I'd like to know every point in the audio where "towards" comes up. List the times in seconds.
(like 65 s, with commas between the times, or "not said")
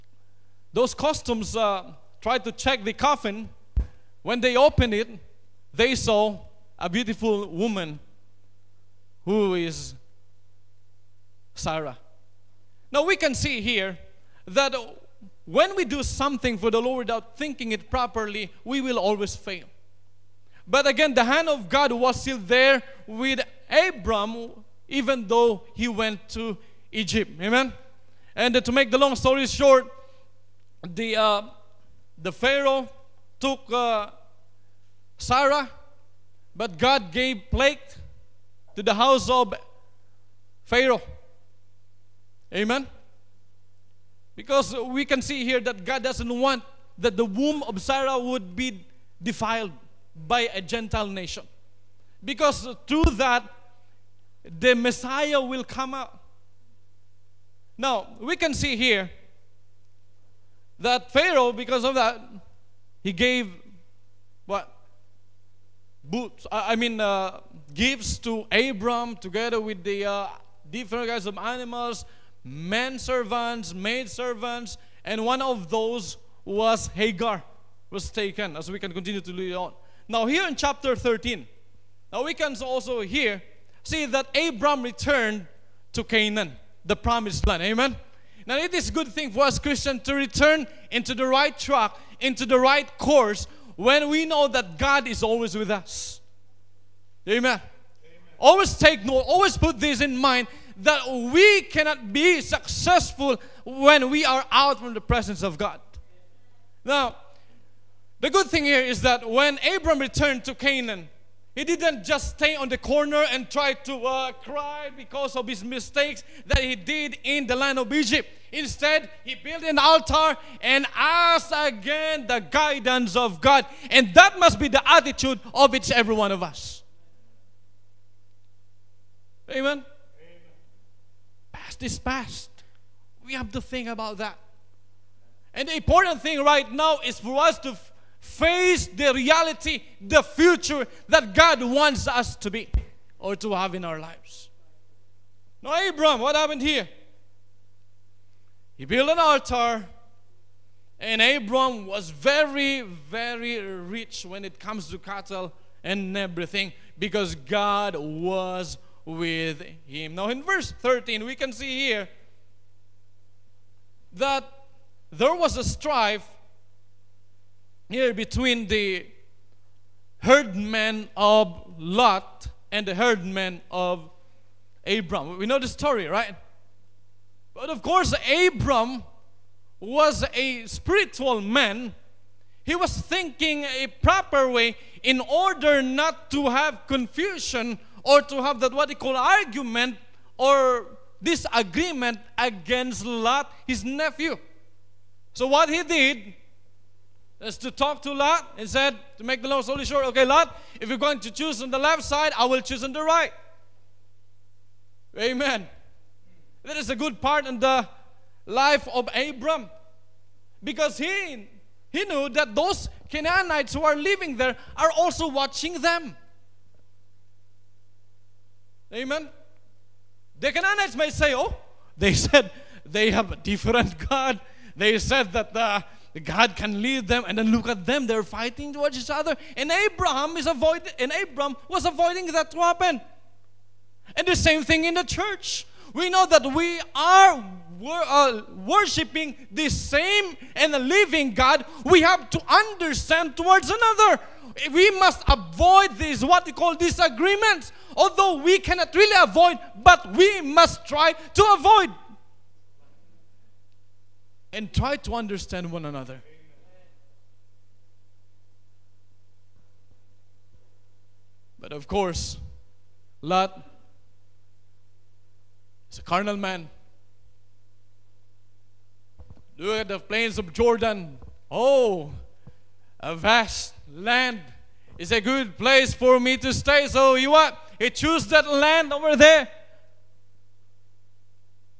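228 s, 243 s.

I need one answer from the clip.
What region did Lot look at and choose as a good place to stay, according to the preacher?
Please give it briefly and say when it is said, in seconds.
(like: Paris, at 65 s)
The plains of Jordan, at 269 s.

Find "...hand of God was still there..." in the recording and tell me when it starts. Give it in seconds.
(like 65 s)
21 s.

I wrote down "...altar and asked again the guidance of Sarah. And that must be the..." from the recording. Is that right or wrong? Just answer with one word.
wrong.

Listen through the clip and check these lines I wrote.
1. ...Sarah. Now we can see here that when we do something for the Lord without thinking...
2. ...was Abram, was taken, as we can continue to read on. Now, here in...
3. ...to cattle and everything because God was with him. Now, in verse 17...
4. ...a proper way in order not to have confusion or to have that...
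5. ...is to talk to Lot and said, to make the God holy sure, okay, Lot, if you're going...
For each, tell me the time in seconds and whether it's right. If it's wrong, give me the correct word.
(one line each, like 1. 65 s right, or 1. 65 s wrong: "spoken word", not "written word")
1. 11 s right
2. 76 s wrong: "Hagar", not "Abram"
3. 154 s wrong: "13", not "17"
4. 183 s right
5. 197 s wrong: "Lord", not "God".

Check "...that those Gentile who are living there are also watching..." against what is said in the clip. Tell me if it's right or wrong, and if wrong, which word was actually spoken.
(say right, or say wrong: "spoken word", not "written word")
wrong: "Canaanites", not "Gentile".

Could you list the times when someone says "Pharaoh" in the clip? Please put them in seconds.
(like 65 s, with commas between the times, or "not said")
32 s, 40 s, 61 s.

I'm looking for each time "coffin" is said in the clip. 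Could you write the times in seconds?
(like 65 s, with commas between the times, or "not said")
2 s.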